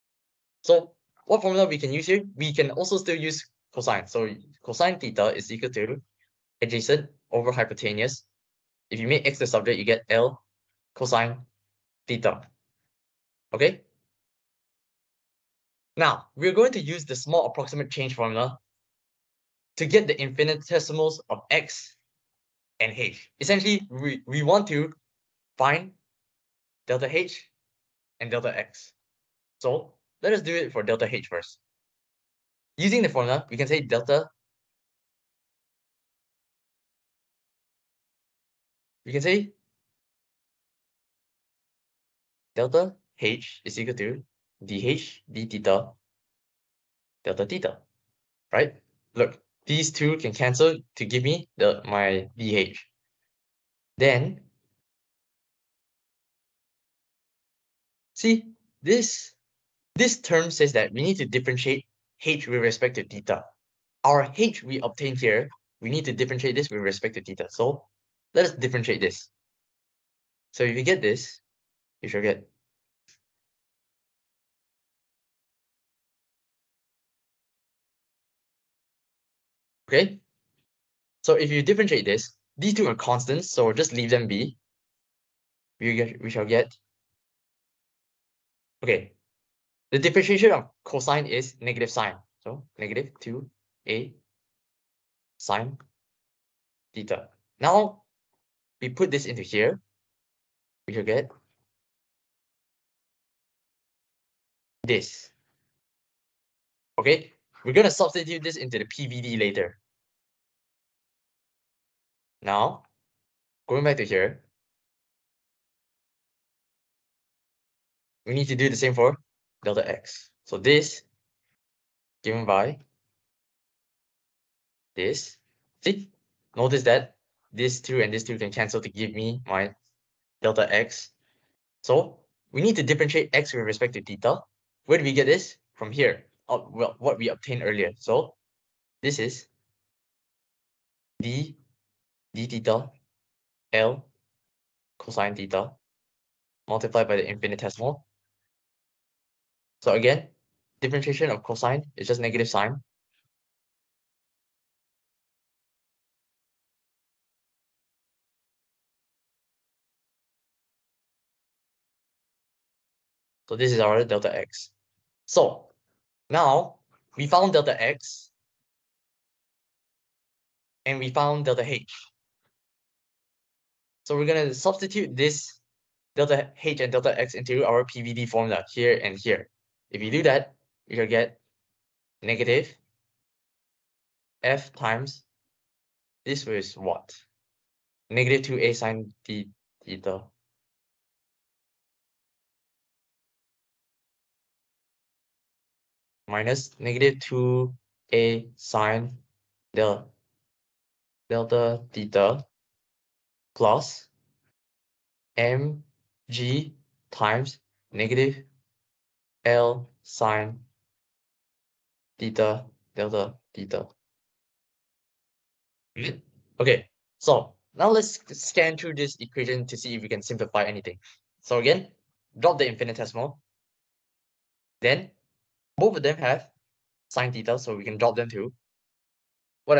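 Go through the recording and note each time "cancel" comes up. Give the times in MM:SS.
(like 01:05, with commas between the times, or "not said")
00:50, 02:08.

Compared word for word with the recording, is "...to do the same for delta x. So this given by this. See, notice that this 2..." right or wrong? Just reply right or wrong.
right.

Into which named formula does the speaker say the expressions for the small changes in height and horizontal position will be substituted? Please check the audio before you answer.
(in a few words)
PVD formula.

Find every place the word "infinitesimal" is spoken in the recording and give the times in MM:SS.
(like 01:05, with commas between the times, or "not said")
00:20, 02:27, 03:42.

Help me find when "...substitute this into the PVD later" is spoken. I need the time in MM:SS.
01:47.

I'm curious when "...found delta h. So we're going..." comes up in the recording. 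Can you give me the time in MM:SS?
02:51.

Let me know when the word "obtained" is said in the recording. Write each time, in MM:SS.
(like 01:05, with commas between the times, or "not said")
01:04, 02:17.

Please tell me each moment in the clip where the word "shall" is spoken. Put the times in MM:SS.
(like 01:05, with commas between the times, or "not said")
01:26, 01:40.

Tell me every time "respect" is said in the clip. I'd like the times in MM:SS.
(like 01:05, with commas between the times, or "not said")
01:02, 01:06, 02:13.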